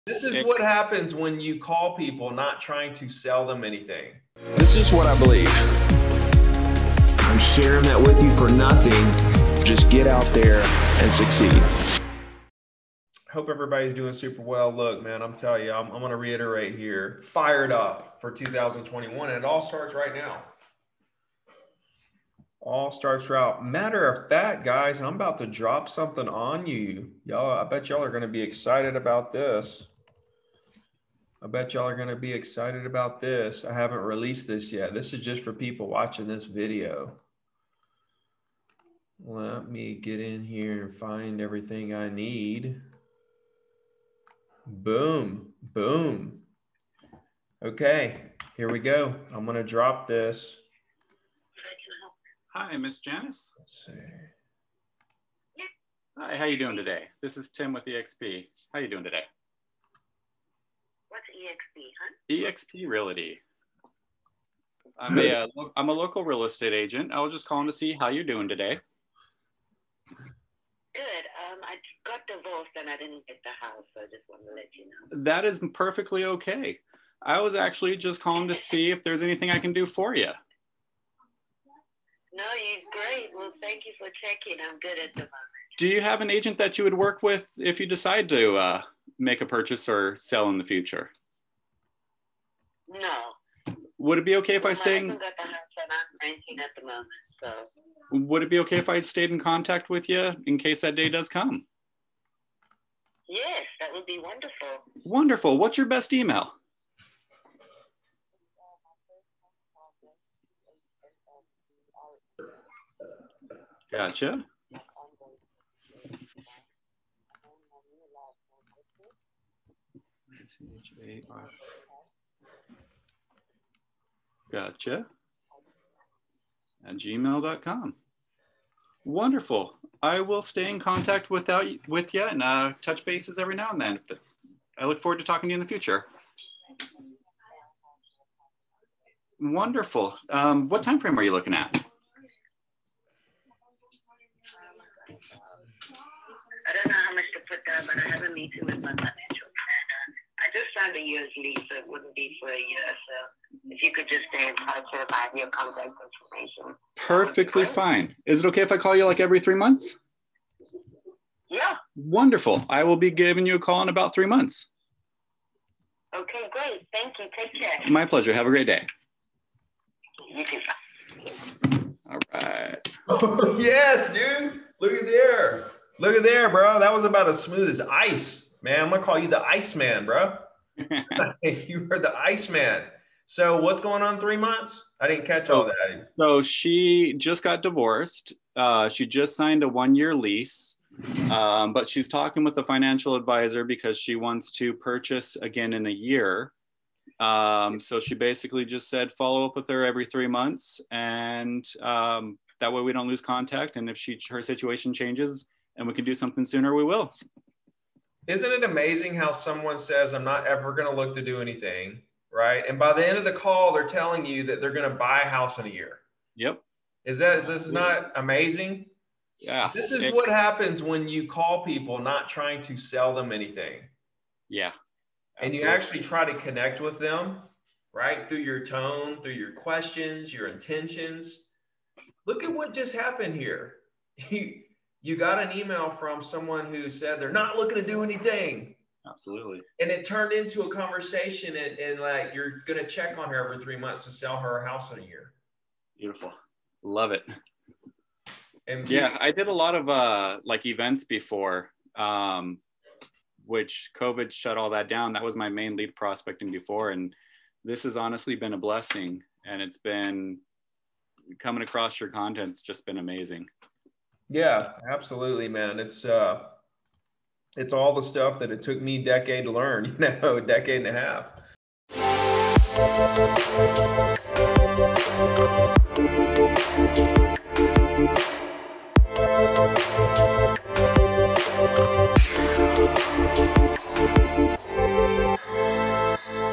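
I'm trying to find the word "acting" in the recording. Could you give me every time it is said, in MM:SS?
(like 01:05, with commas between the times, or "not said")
not said.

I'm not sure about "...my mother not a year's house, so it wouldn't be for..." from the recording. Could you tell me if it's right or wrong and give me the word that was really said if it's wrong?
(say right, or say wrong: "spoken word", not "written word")
wrong: "lease", not "house".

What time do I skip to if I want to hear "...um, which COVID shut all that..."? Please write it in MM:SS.
04:11.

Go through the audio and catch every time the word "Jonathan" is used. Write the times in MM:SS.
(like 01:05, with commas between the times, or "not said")
not said.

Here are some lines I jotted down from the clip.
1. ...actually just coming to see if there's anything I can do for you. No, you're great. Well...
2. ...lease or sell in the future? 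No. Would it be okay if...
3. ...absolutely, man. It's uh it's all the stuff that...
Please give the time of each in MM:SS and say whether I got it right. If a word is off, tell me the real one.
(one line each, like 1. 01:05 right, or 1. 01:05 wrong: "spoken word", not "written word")
1. 01:17 wrong: "calling", not "coming"
2. 01:29 wrong: "purchase", not "lease"
3. 04:24 right.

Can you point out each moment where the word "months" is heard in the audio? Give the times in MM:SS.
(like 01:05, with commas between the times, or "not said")
02:39, 02:44, 03:04, 03:20, 04:03.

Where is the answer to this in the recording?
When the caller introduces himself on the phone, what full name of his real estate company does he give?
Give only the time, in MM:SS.
01:02.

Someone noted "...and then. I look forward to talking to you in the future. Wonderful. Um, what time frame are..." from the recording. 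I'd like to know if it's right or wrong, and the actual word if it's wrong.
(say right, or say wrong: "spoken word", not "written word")
right.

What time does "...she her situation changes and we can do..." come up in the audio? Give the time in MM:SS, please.
03:23.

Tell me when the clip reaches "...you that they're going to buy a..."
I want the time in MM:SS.
03:34.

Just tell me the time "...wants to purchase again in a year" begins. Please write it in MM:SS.
03:14.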